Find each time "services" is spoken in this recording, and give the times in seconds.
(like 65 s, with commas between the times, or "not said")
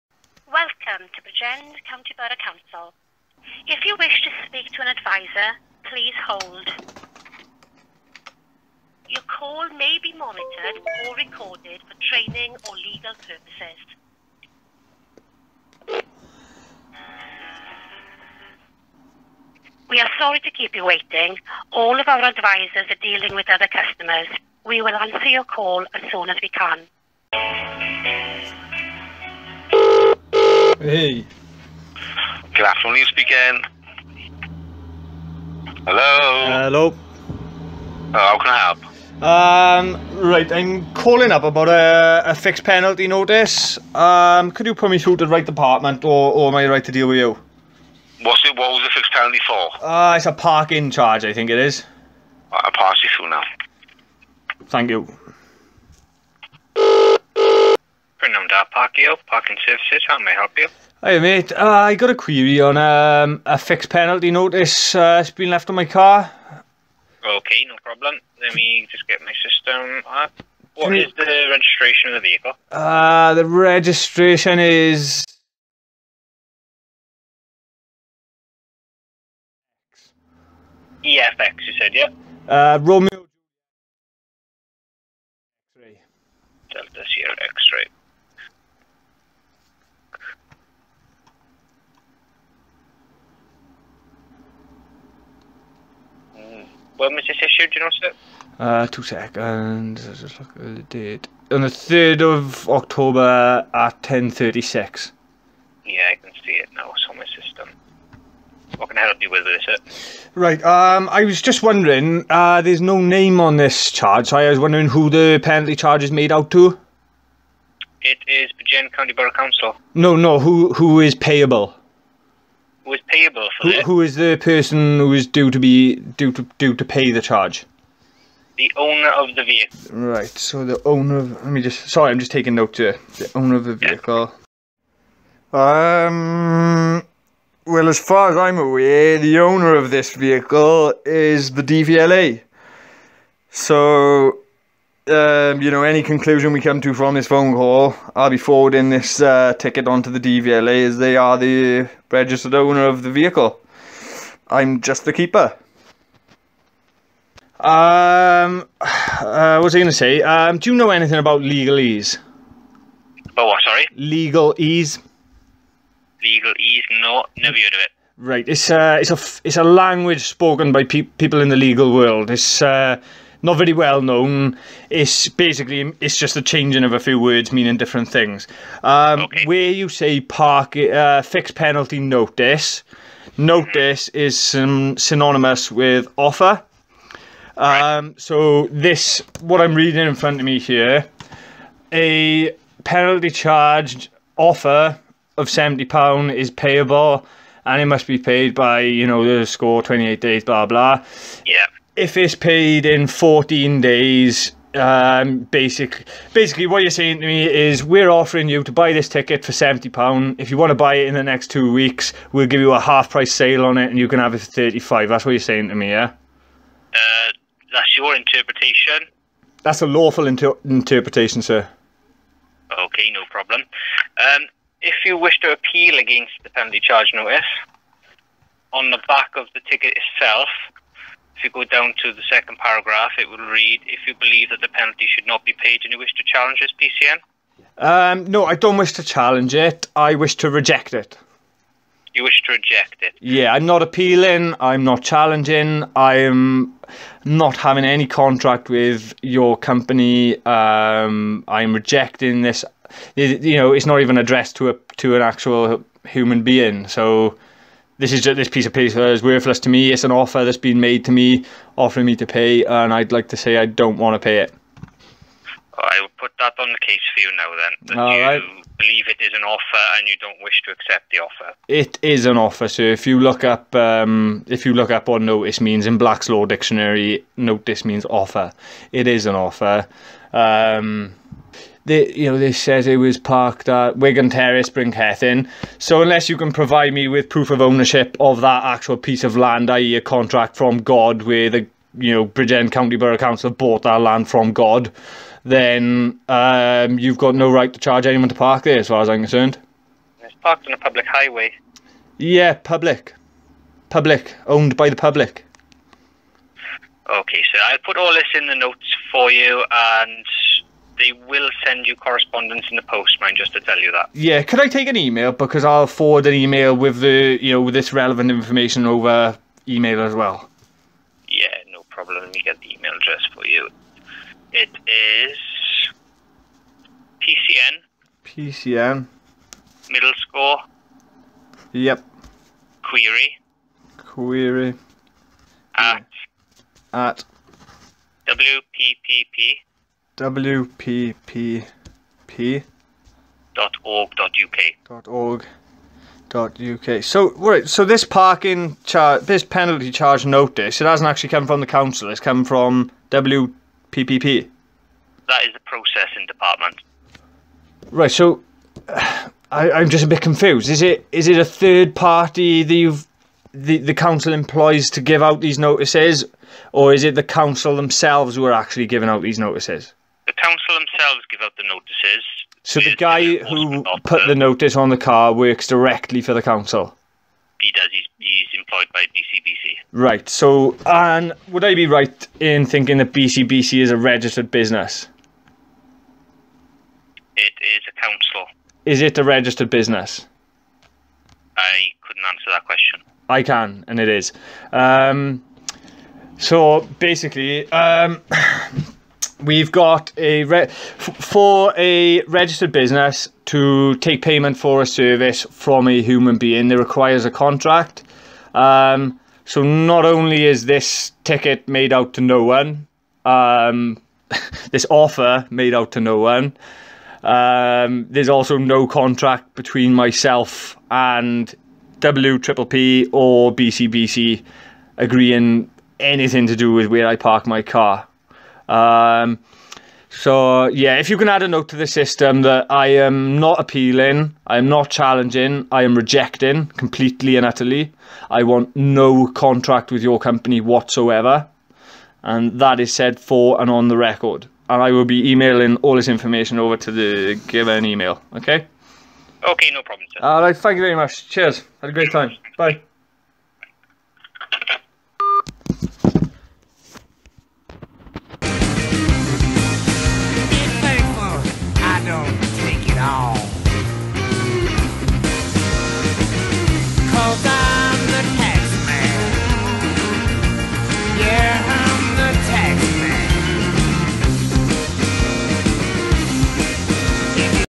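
59 s, 404 s.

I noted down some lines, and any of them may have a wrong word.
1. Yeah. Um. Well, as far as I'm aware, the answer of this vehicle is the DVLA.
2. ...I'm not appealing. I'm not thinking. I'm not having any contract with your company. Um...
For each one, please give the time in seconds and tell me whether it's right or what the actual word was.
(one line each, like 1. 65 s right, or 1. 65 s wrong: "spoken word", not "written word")
1. 135 s wrong: "owner", not "answer"
2. 243 s wrong: "challenging", not "thinking".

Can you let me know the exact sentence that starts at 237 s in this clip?
Um, no, I don't wish to challenge it.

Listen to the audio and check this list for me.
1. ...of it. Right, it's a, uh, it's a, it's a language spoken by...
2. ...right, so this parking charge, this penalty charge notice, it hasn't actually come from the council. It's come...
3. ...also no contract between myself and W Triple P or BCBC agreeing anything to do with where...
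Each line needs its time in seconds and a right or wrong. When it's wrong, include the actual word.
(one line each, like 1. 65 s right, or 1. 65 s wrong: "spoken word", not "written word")
1. 167 s right
2. 347 s right
3. 418 s right.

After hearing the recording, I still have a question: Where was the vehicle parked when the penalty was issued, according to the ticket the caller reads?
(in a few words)
Bryncethin.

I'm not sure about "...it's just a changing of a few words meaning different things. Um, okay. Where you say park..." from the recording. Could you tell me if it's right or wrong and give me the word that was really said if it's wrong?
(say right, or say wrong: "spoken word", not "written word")
right.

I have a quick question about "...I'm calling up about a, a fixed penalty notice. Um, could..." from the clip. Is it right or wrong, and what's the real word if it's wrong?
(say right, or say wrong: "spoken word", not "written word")
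right.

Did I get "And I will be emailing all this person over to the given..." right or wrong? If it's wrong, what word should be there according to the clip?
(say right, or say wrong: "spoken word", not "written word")
wrong: "information", not "person".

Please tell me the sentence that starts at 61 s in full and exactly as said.
Hi mate, uh, I got a query on um, a fixed penalty notice uh, it's been left on my car.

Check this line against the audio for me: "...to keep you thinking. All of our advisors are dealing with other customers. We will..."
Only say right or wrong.
wrong.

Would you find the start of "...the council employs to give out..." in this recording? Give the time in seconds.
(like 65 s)
363 s.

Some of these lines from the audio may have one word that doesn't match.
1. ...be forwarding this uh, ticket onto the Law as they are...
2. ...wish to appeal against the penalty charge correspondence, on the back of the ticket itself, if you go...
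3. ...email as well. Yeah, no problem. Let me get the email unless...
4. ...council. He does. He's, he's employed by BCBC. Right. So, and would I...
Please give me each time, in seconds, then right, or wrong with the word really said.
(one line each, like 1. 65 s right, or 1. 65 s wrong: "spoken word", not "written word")
1. 148 s wrong: "DVLA", not "Law"
2. 225 s wrong: "notice", not "correspondence"
3. 319 s wrong: "address", not "unless"
4. 376 s right.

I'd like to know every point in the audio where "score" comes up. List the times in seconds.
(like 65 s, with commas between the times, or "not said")
199 s, 330 s.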